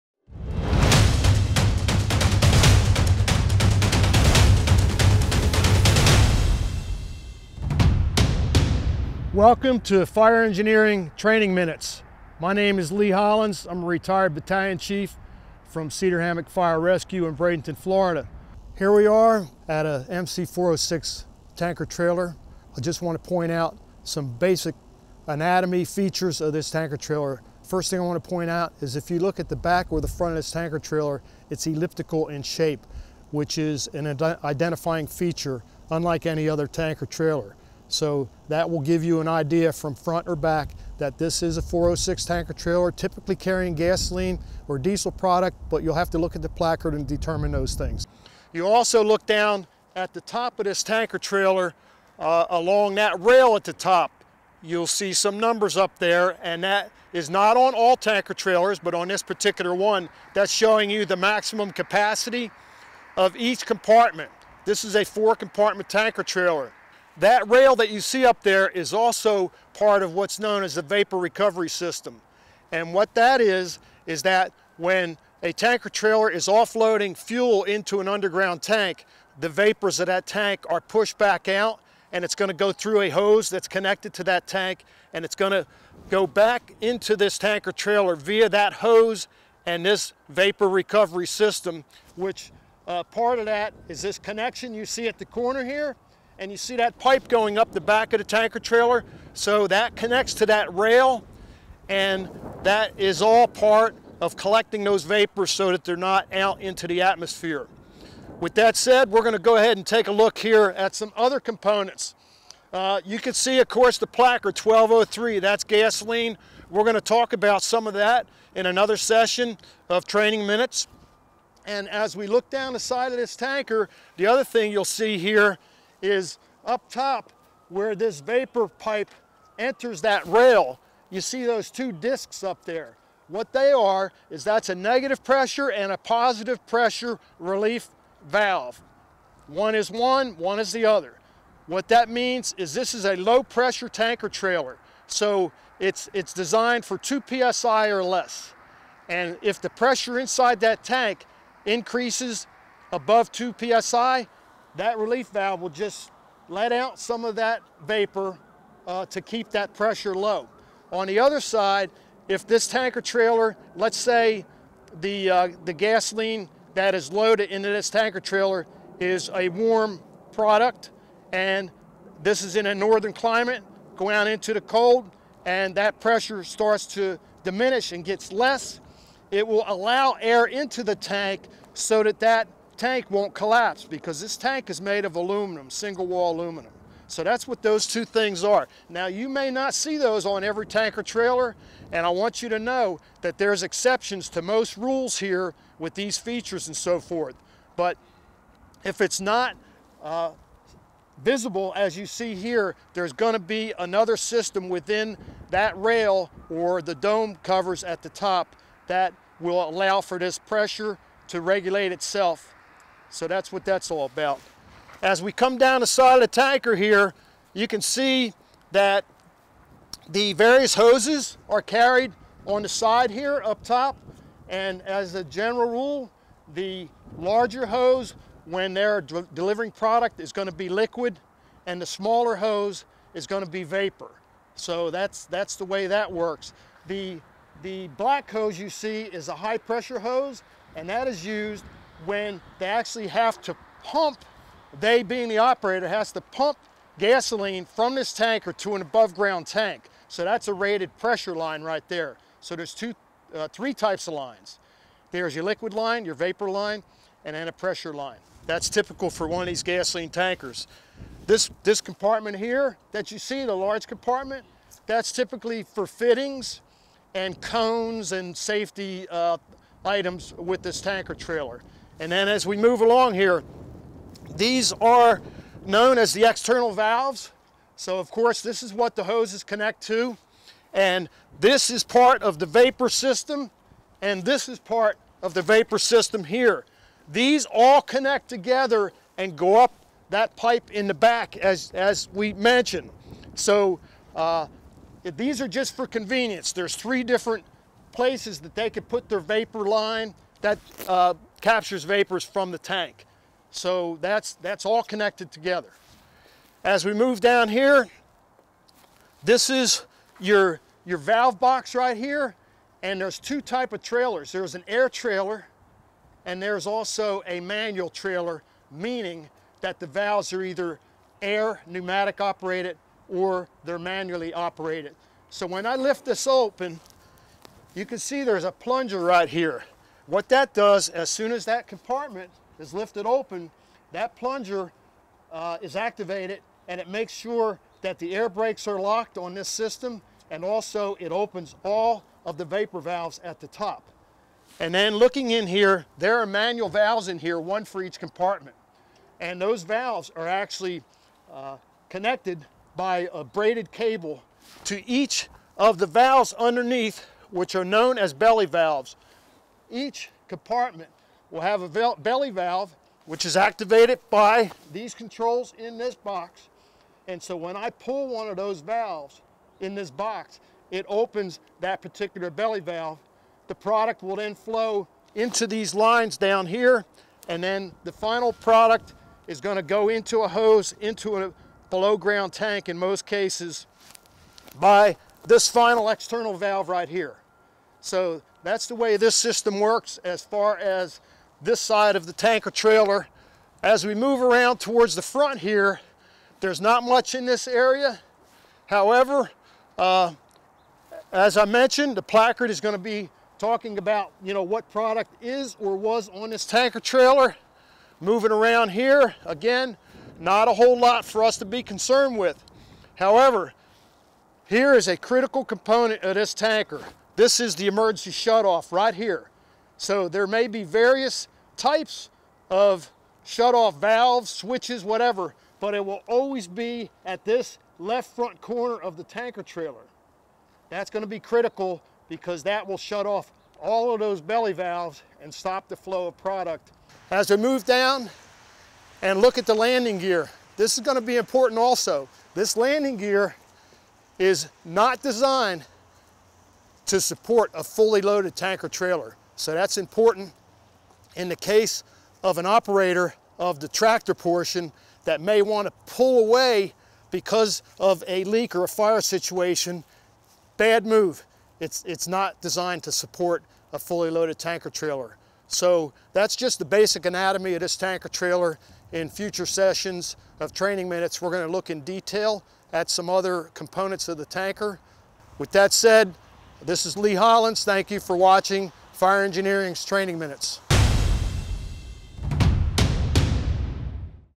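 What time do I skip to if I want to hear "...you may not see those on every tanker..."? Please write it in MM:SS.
03:09.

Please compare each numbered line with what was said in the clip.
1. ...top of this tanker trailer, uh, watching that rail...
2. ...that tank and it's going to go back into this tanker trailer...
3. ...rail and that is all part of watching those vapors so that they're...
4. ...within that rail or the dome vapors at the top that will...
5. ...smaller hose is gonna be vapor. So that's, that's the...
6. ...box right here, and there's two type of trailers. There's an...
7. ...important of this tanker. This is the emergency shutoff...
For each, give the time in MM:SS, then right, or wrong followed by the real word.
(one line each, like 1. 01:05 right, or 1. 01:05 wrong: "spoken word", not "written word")
1. 00:50 wrong: "along", not "watching"
2. 01:24 right
3. 01:40 wrong: "collecting", not "watching"
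4. 03:24 wrong: "covers", not "vapors"
5. 03:51 right
6. 05:11 right
7. 06:55 wrong: "component", not "important".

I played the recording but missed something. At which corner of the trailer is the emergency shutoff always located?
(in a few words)
Left front corner.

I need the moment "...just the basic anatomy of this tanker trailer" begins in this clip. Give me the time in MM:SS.
07:46.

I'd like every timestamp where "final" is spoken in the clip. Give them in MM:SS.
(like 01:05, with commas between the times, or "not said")
06:17, 06:25.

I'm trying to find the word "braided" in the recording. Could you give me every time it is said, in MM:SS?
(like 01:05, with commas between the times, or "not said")
05:53.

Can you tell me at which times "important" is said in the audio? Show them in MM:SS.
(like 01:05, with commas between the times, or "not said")
07:21, 07:29.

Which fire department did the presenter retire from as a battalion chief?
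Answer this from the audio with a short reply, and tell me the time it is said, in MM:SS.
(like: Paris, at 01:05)
Cedar Hammock Fire Rescue, at 00:15.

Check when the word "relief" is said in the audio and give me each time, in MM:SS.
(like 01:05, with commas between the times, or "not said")
02:17, 02:34.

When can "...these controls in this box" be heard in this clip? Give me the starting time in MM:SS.
06:04.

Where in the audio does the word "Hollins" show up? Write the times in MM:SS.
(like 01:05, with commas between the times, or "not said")
00:13, 07:57.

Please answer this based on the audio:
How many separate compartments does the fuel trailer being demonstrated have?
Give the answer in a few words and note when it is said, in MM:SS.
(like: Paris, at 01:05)
4, at 01:05.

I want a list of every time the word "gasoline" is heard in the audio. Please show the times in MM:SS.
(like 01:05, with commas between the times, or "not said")
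00:43, 01:55, 02:45, 04:06, 04:19.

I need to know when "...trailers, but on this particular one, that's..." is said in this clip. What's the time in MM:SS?
00:58.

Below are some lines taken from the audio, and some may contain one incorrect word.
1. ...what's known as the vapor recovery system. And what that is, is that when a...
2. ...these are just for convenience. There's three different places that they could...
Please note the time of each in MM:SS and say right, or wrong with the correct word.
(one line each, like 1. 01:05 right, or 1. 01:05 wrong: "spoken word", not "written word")
1. 01:10 right
2. 04:55 right.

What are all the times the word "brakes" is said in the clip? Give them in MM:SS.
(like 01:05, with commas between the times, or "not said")
05:38.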